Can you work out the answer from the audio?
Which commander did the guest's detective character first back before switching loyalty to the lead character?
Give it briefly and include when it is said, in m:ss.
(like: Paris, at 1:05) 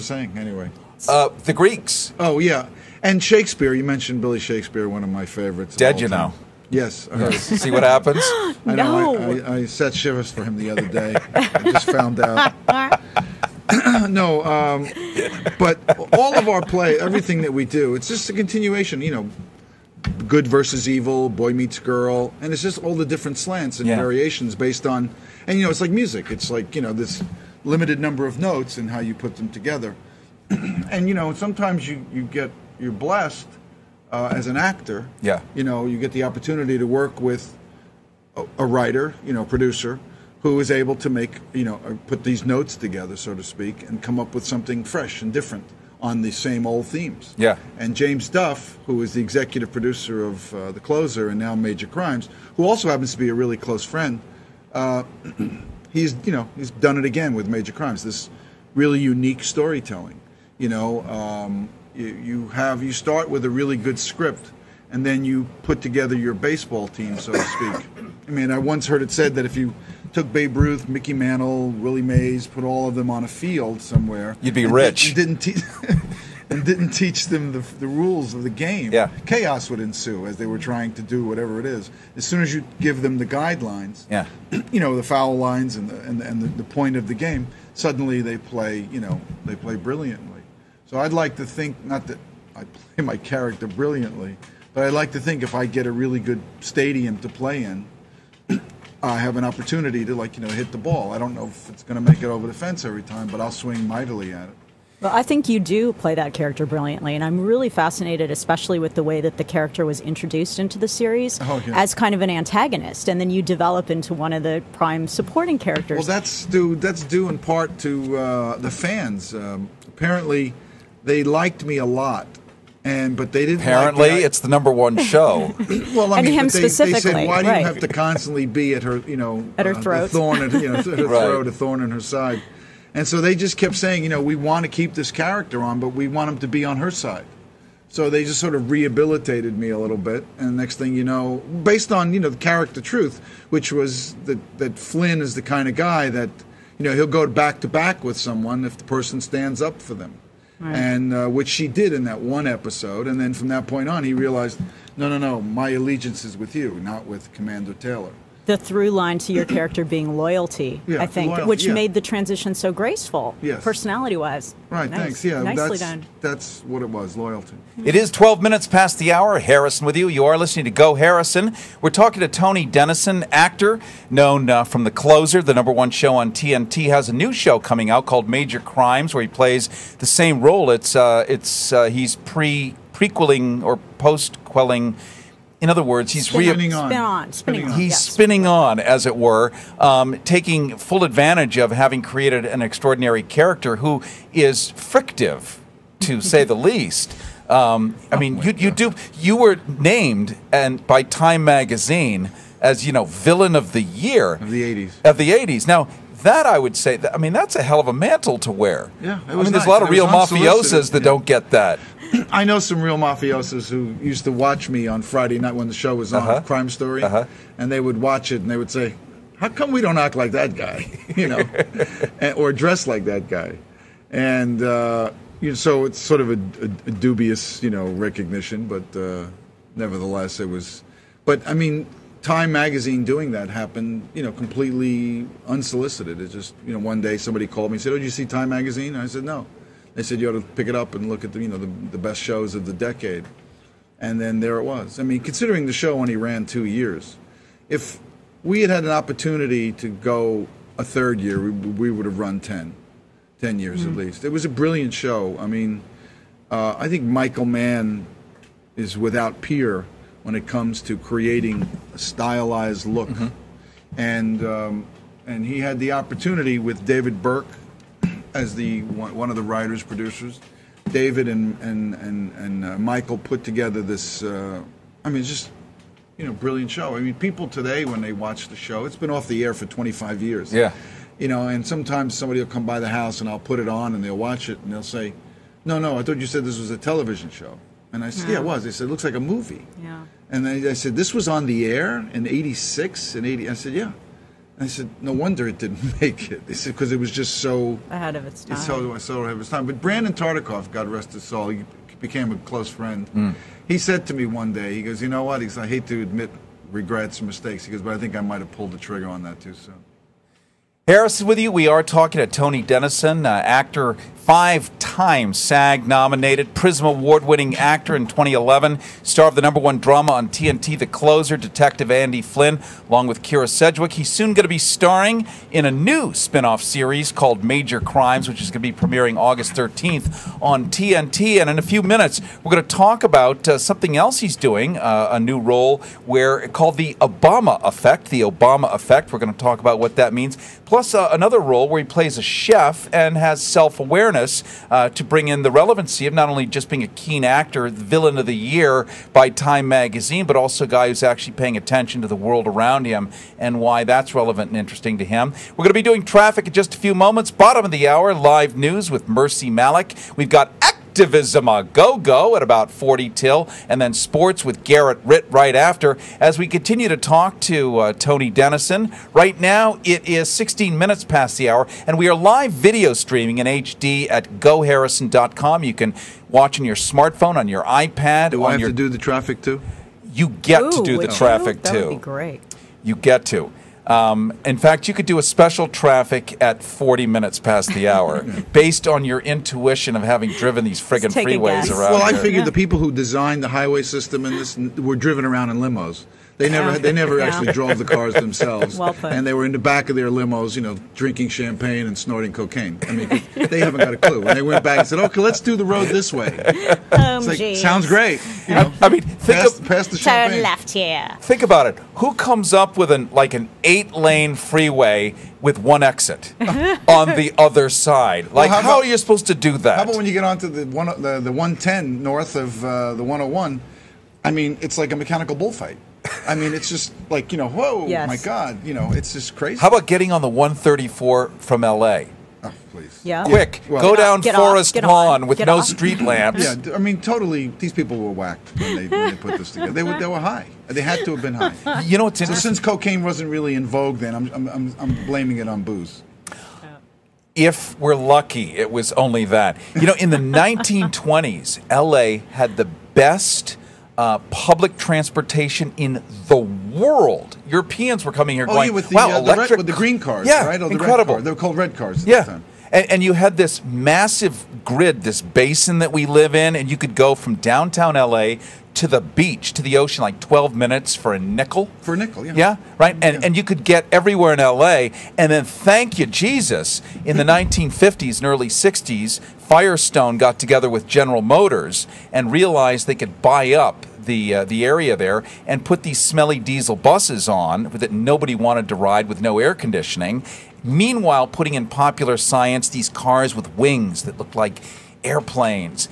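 Commander Taylor, at 2:37.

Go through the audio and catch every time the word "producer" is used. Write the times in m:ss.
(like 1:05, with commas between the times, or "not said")
0:39, 0:49, 4:29.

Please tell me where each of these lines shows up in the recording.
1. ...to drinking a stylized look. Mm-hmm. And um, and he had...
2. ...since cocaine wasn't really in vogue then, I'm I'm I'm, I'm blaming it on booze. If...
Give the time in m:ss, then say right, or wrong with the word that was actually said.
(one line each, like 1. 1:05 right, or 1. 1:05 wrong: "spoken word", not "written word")
1. 4:20 wrong: "creating", not "drinking"
2. 7:22 right.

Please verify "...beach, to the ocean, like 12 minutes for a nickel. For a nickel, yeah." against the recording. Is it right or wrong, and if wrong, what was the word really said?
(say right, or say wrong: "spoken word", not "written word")
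right.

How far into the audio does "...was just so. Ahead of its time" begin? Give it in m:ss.
4:56.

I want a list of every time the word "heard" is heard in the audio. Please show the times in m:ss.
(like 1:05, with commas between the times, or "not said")
0:07, 1:08.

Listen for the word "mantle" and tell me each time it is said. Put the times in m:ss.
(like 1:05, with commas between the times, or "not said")
1:11, 3:27.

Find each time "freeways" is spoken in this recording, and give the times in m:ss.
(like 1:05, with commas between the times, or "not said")
6:31, 6:54.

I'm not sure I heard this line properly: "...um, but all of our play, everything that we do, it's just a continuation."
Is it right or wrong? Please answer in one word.
right.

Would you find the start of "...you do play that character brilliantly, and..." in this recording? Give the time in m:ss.
1:45.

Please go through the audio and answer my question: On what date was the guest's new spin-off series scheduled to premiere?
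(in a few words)
August 13th.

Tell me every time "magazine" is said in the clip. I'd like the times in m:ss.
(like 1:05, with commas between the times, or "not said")
3:21, 3:52, 3:58, 5:49.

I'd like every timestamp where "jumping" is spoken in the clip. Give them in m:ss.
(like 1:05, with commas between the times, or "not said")
not said.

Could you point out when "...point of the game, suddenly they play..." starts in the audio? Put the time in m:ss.
1:26.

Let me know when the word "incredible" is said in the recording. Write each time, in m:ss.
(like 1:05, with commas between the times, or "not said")
7:40.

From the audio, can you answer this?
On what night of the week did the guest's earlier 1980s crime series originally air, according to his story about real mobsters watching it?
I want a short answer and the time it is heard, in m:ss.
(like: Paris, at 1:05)
Friday, at 3:35.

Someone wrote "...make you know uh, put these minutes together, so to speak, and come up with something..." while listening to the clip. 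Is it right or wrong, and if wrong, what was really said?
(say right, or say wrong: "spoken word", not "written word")
wrong: "notes", not "minutes".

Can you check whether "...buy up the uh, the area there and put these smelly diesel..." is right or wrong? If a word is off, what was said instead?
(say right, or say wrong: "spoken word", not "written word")
right.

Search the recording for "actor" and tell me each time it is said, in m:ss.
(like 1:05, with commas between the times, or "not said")
0:34, 2:53, 5:13, 5:17, 5:47.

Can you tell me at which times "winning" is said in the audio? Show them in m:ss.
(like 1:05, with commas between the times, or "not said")
5:17.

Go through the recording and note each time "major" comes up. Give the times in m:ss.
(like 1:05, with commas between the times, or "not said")
0:51, 0:57, 2:58, 5:27.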